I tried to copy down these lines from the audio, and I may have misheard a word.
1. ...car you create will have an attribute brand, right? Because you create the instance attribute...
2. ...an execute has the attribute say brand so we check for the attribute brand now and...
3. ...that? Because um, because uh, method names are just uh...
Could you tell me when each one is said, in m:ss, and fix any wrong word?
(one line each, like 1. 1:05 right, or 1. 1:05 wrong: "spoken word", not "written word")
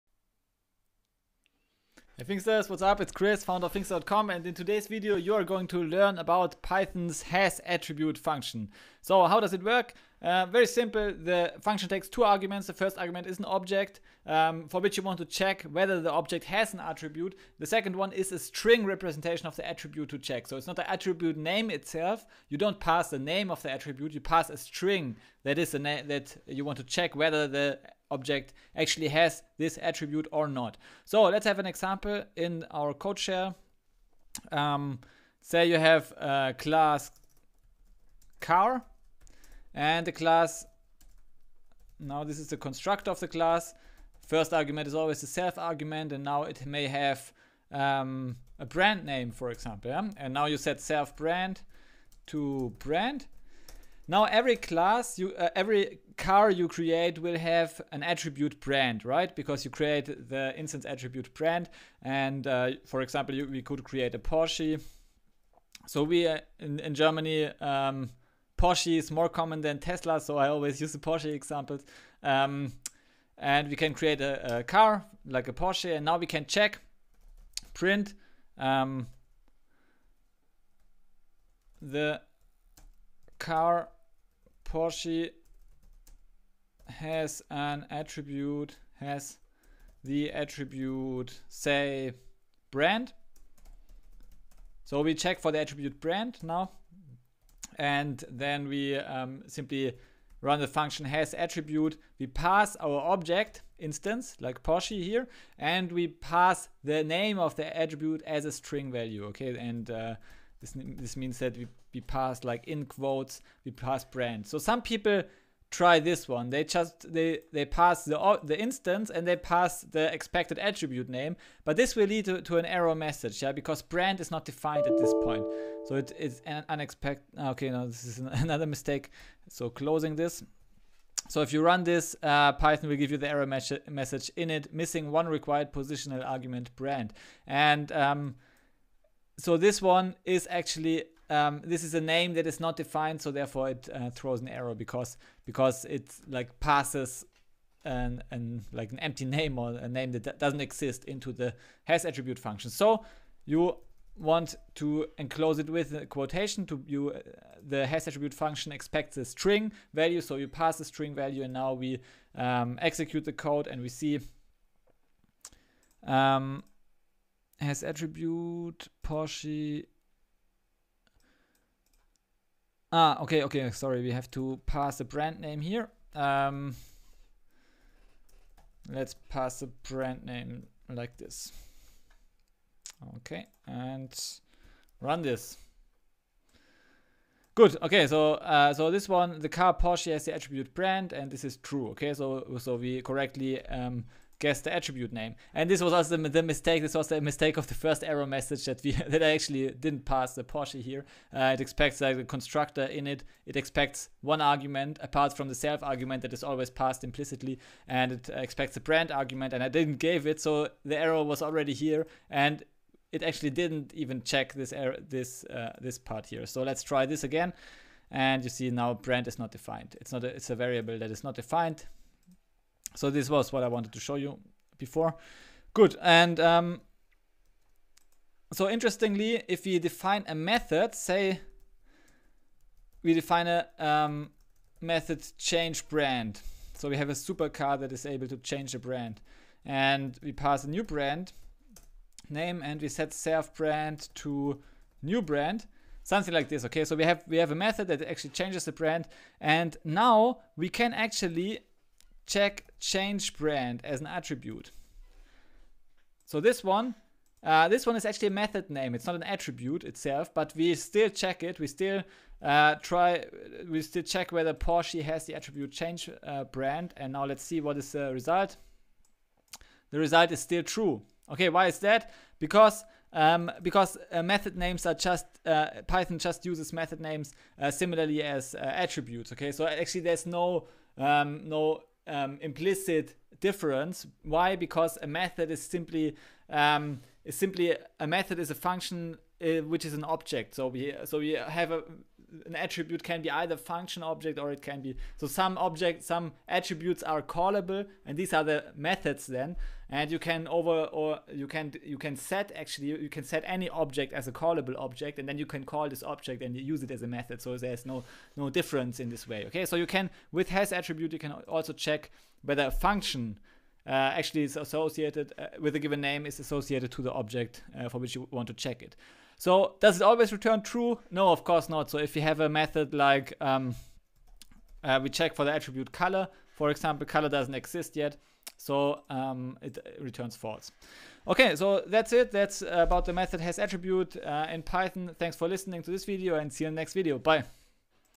1. 0:56 right
2. 1:27 wrong: "attribute", not "execute"
3. 4:31 right.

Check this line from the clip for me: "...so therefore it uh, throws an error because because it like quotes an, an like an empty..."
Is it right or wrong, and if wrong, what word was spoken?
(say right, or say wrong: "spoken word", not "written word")
wrong: "passes", not "quotes".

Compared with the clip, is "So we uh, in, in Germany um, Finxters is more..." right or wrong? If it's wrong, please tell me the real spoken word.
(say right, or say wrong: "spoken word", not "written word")
wrong: "Porsche", not "Finxters".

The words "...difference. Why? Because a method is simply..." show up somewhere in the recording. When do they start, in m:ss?
4:43.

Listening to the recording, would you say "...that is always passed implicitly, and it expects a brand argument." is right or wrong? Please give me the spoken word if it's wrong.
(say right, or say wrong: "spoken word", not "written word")
right.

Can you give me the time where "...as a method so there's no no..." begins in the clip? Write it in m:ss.
5:06.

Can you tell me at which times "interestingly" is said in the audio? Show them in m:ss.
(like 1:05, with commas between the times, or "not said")
3:48.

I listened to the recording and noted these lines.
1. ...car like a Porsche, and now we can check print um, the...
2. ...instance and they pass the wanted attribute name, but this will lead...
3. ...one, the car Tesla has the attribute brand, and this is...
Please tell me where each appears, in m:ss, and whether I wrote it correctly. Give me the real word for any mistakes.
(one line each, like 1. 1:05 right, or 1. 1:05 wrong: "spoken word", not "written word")
1. 1:14 right
2. 1:58 wrong: "expected", not "wanted"
3. 3:09 wrong: "Porsche", not "Tesla".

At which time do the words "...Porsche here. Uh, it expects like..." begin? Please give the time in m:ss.
3:20.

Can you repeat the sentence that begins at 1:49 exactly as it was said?
And uh, this, this means that we, we pass like in quotes, we pass brand.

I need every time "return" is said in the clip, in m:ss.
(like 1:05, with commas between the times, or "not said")
5:20, 5:29.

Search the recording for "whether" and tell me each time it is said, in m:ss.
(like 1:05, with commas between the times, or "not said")
0:15, 0:27, 4:24, 5:12.